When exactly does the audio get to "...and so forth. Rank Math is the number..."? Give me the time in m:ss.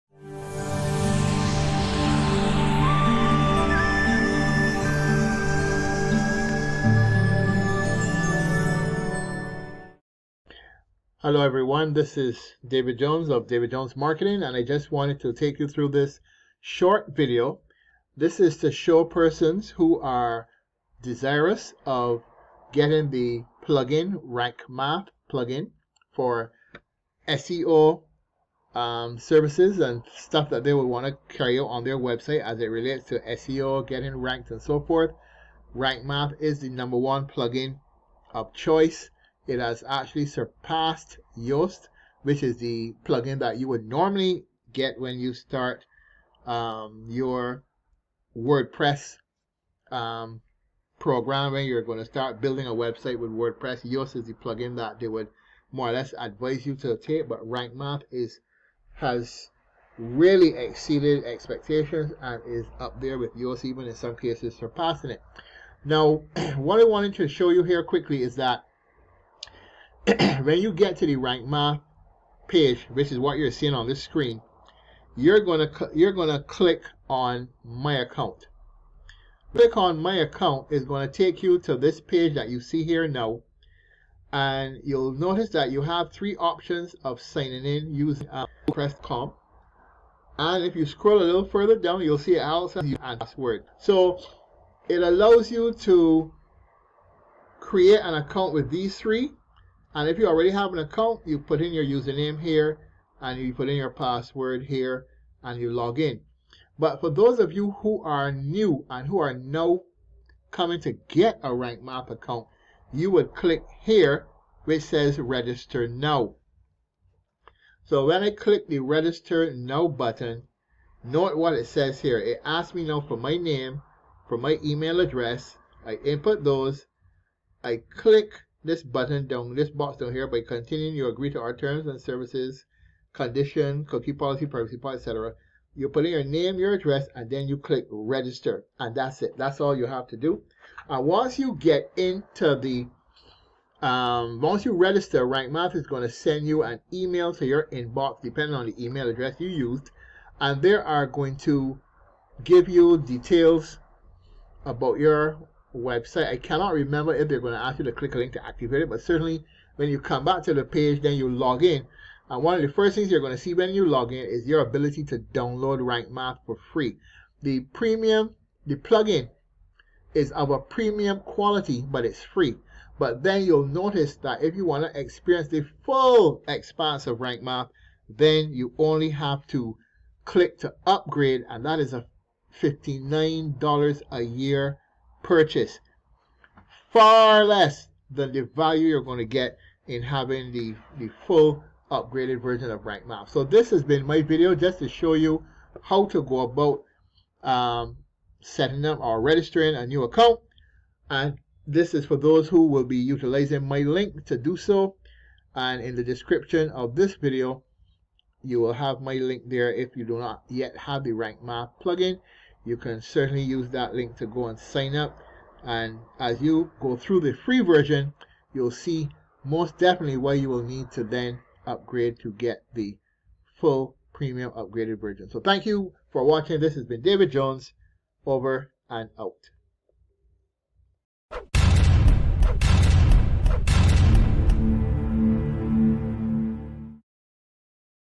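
0:34.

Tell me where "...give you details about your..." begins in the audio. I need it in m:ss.
2:32.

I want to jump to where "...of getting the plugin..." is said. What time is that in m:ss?
0:21.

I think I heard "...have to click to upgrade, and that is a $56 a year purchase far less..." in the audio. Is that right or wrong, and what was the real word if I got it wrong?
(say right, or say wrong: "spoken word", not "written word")
wrong: "59", not "56".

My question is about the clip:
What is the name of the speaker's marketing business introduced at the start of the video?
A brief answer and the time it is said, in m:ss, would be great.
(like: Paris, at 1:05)
David Jones Marketing, at 0:13.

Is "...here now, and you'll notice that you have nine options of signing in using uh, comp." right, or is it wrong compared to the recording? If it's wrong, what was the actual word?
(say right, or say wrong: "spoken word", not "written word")
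wrong: "three", not "nine".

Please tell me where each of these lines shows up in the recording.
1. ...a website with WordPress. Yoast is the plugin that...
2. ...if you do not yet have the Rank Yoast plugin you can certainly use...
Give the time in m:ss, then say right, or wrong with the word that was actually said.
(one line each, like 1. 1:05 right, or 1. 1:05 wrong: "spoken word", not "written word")
1. 0:52 right
2. 3:29 wrong: "Math", not "Yoast".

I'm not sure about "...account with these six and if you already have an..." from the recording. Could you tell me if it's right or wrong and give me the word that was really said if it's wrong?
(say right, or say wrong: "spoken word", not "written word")
wrong: "three", not "six".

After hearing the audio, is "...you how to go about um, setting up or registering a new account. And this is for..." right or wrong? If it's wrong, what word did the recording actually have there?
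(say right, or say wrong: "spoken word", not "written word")
right.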